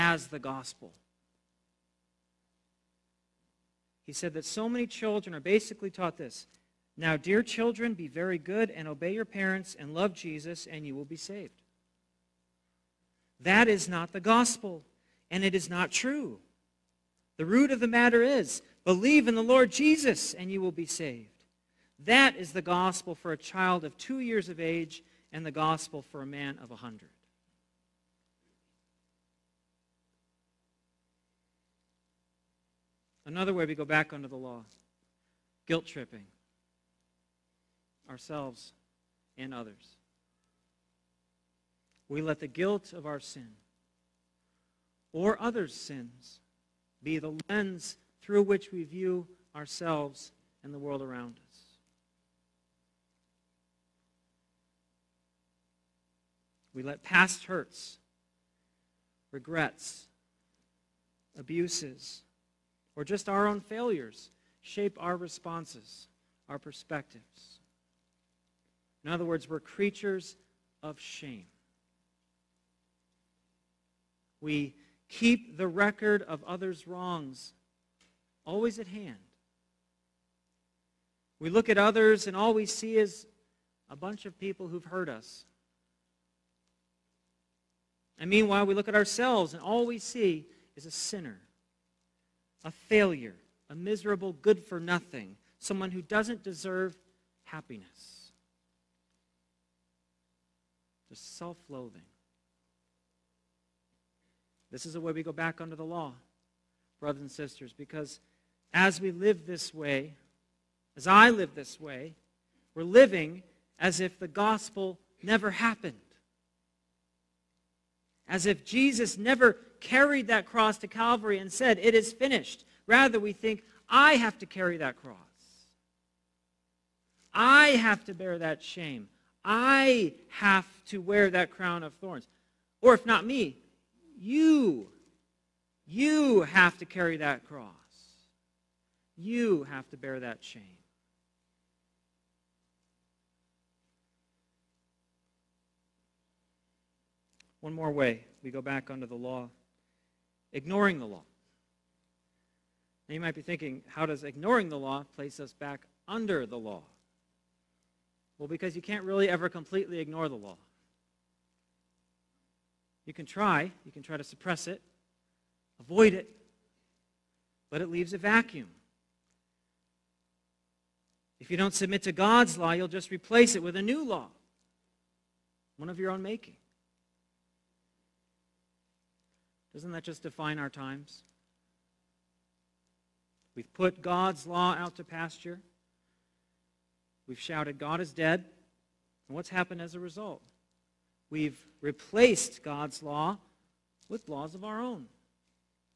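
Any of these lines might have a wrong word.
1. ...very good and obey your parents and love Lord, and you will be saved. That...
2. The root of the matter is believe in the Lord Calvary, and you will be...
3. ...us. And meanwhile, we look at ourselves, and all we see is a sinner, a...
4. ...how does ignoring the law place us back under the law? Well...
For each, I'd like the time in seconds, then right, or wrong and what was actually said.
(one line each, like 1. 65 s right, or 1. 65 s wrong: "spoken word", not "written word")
1. 8 s wrong: "Jesus", not "Lord"
2. 17 s wrong: "Jesus", not "Calvary"
3. 85 s right
4. 153 s right.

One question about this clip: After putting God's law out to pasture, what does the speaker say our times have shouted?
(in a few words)
God is dead.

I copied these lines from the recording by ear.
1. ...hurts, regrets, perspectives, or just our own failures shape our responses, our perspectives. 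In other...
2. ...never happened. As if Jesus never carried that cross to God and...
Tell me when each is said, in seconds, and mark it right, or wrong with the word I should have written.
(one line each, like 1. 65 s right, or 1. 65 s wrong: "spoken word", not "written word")
1. 57 s wrong: "abuses", not "perspectives"
2. 115 s wrong: "Calvary", not "God".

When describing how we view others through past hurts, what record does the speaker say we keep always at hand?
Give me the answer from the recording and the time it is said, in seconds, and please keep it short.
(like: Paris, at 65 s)
others' wrongs, at 76 s.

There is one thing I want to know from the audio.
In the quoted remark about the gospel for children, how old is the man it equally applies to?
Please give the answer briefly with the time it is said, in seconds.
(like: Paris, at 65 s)
100, at 26 s.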